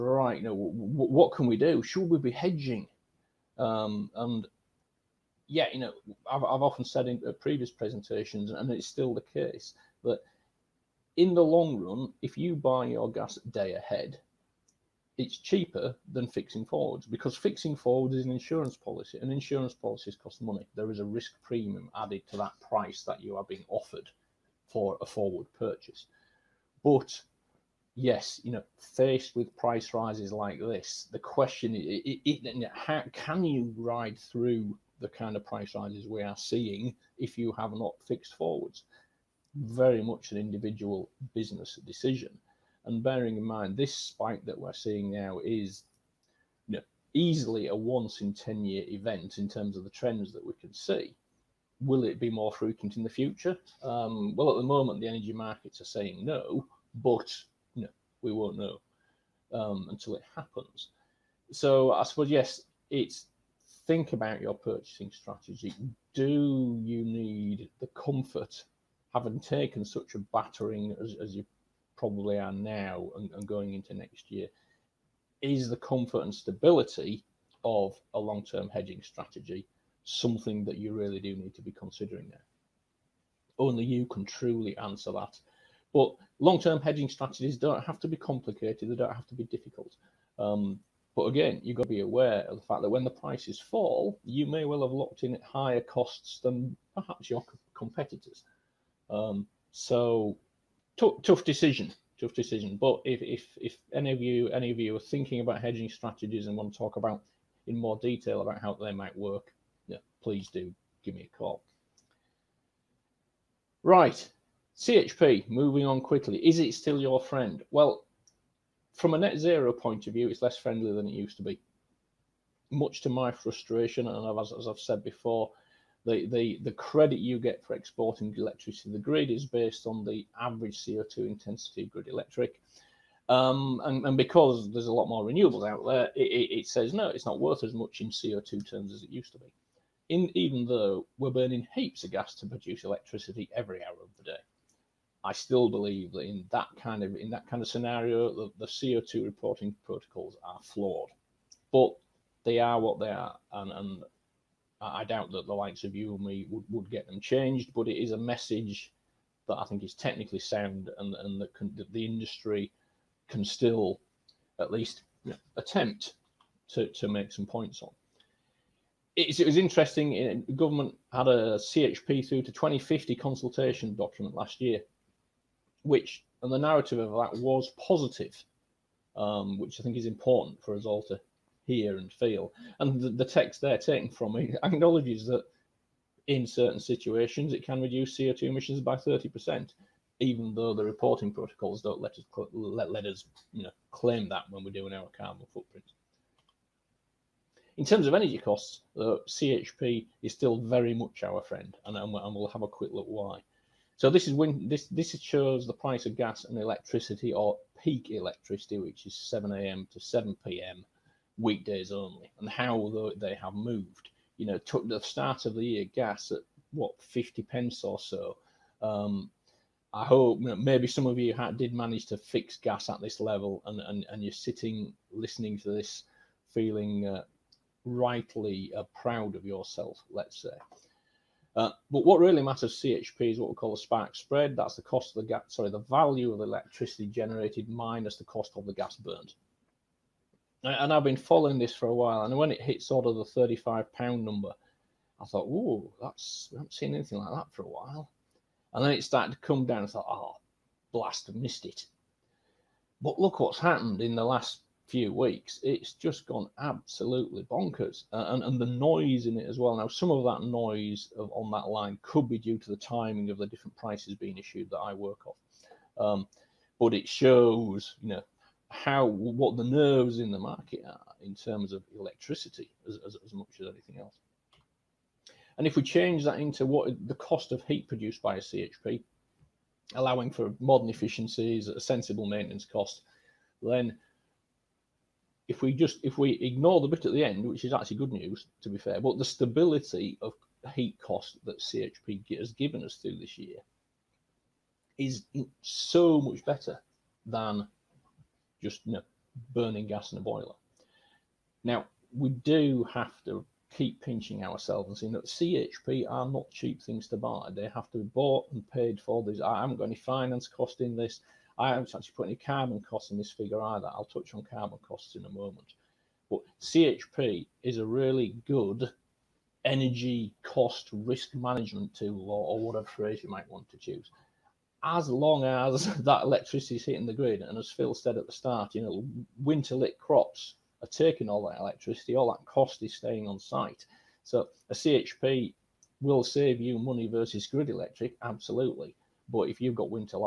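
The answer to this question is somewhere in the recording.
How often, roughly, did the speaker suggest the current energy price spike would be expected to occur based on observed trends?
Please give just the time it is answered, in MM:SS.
00:47.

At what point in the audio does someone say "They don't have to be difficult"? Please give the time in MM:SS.
01:28.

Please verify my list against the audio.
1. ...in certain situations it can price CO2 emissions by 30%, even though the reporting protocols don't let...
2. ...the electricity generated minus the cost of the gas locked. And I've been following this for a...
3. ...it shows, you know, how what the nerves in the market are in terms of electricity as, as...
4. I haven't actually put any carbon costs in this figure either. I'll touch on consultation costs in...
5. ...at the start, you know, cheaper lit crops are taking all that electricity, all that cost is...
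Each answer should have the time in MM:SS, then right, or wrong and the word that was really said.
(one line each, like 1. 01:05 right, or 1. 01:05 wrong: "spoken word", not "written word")
1. 03:06 wrong: "reduce", not "price"
2. 03:56 wrong: "burned", not "locked"
3. 04:26 right
4. 05:11 wrong: "carbon", not "consultation"
5. 05:28 wrong: "winter", not "cheaper".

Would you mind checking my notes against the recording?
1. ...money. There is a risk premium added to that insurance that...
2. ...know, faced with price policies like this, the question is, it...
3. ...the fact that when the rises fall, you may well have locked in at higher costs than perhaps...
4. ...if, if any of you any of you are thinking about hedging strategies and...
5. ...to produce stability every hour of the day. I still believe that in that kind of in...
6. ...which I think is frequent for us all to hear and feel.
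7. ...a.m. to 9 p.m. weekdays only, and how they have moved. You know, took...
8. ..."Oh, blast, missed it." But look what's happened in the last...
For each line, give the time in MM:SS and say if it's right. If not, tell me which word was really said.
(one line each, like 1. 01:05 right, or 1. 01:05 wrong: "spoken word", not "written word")
1. 00:20 wrong: "price", not "insurance"
2. 00:28 wrong: "rises", not "policies"
3. 01:32 wrong: "prices", not "rises"
4. 01:43 right
5. 02:22 wrong: "electricity", not "stability"
6. 02:59 wrong: "important", not "frequent"
7. 03:29 wrong: "7", not "9"
8. 04:10 right.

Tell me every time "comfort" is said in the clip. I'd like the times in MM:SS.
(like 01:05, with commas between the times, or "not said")
01:07, 01:15.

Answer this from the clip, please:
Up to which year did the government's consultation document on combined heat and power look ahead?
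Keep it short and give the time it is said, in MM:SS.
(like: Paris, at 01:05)
2050, at 02:52.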